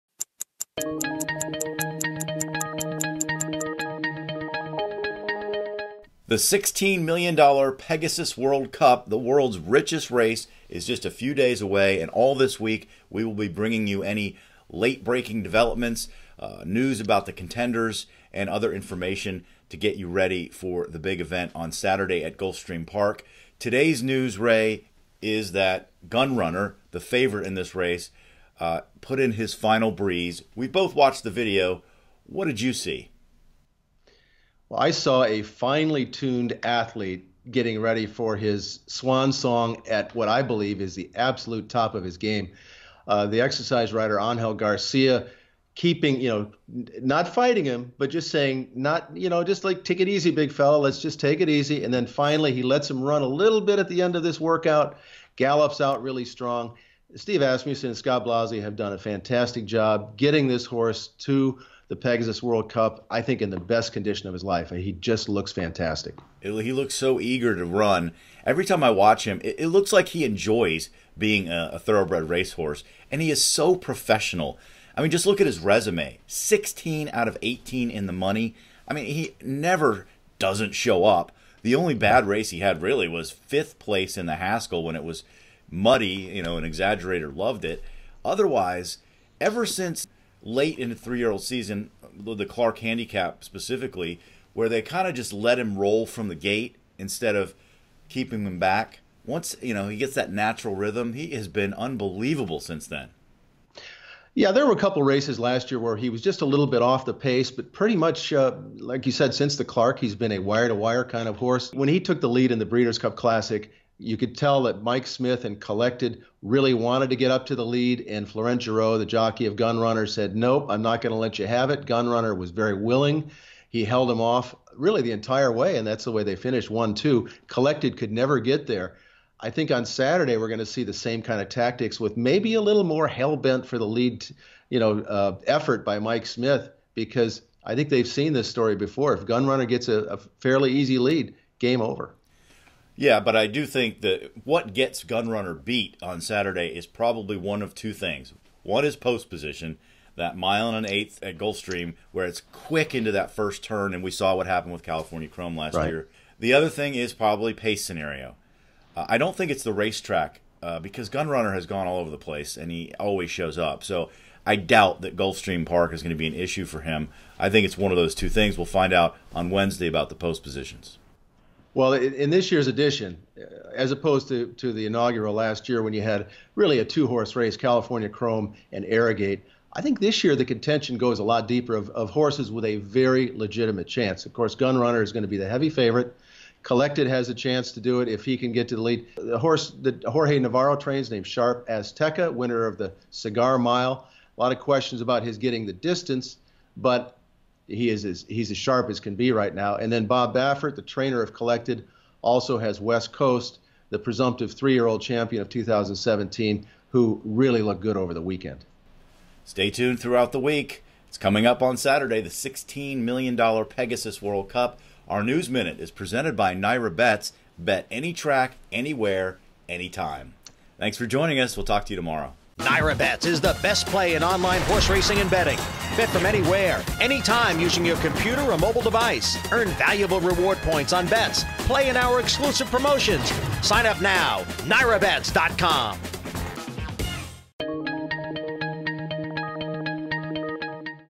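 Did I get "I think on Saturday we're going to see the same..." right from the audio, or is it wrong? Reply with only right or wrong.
right.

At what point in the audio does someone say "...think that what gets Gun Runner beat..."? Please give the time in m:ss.
2:23.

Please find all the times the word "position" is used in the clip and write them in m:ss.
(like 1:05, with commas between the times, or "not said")
2:29, 2:50.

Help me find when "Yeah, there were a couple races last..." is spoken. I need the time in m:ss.
1:44.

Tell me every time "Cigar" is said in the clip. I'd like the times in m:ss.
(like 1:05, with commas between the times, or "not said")
3:13.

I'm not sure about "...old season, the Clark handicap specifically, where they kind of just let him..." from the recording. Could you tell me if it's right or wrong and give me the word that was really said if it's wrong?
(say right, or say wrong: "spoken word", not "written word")
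right.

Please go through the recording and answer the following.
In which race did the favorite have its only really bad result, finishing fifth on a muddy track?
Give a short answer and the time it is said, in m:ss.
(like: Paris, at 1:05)
the Haskell, at 1:24.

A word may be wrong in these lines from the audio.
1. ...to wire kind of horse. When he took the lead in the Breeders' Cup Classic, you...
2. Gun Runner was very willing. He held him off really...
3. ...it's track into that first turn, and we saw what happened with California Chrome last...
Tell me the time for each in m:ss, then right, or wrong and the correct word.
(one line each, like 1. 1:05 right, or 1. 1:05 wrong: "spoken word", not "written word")
1. 1:50 right
2. 2:01 right
3. 2:32 wrong: "quick", not "track".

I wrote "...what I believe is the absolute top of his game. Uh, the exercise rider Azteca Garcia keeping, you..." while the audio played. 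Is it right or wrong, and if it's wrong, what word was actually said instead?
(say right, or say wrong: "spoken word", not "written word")
wrong: "Angel", not "Azteca".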